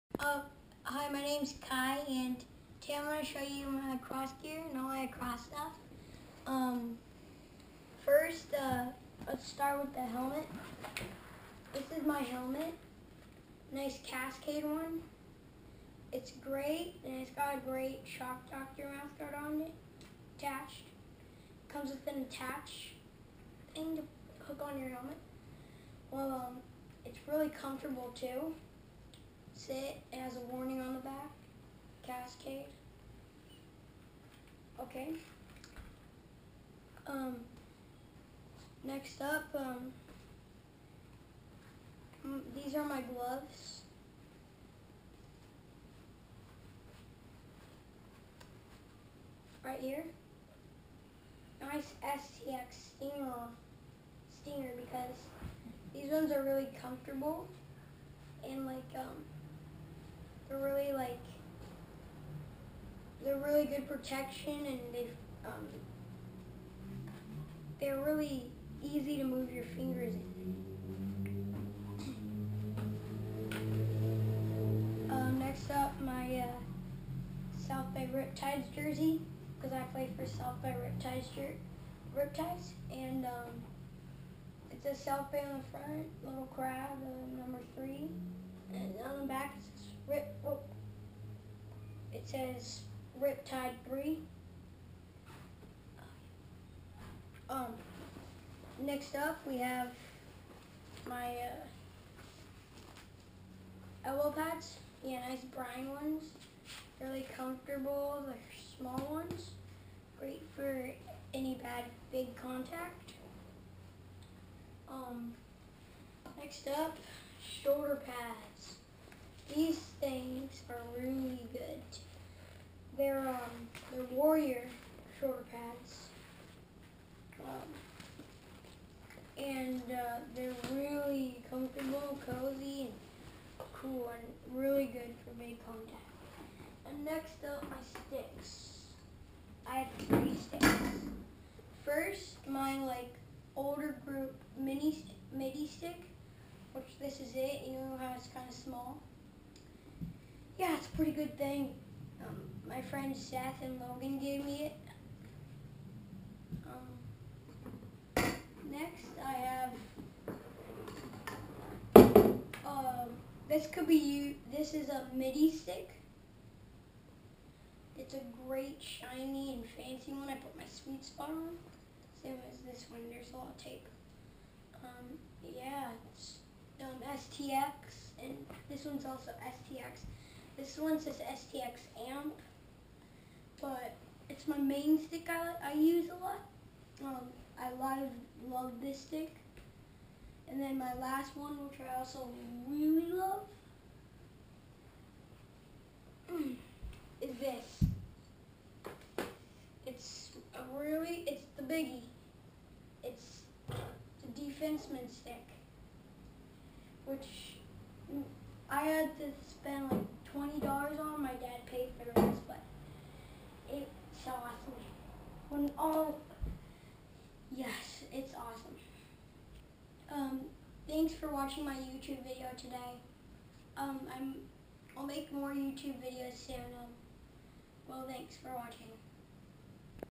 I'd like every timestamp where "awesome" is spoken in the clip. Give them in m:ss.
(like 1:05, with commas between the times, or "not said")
3:34, 3:38.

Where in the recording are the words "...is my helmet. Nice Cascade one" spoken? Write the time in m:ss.
0:11.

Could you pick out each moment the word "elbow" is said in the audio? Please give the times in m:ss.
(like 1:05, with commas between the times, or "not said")
1:44.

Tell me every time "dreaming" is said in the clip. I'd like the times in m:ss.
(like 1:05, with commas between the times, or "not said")
not said.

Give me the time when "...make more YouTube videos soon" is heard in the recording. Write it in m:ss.
3:45.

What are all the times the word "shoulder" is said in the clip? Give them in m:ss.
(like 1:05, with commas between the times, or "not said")
1:57, 2:05.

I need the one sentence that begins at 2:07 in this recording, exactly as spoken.
Um, and uh, they're really comfortable, cozy, and cool, and really good for big contact.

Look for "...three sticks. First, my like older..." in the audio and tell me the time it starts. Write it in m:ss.
2:20.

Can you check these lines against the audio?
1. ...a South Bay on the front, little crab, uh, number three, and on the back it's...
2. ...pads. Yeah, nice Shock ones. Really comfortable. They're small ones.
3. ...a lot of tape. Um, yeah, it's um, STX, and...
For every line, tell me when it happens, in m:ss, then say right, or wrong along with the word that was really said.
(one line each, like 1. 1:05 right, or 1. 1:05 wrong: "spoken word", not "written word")
1. 1:24 right
2. 1:44 wrong: "Brine", not "Shock"
3. 2:53 right.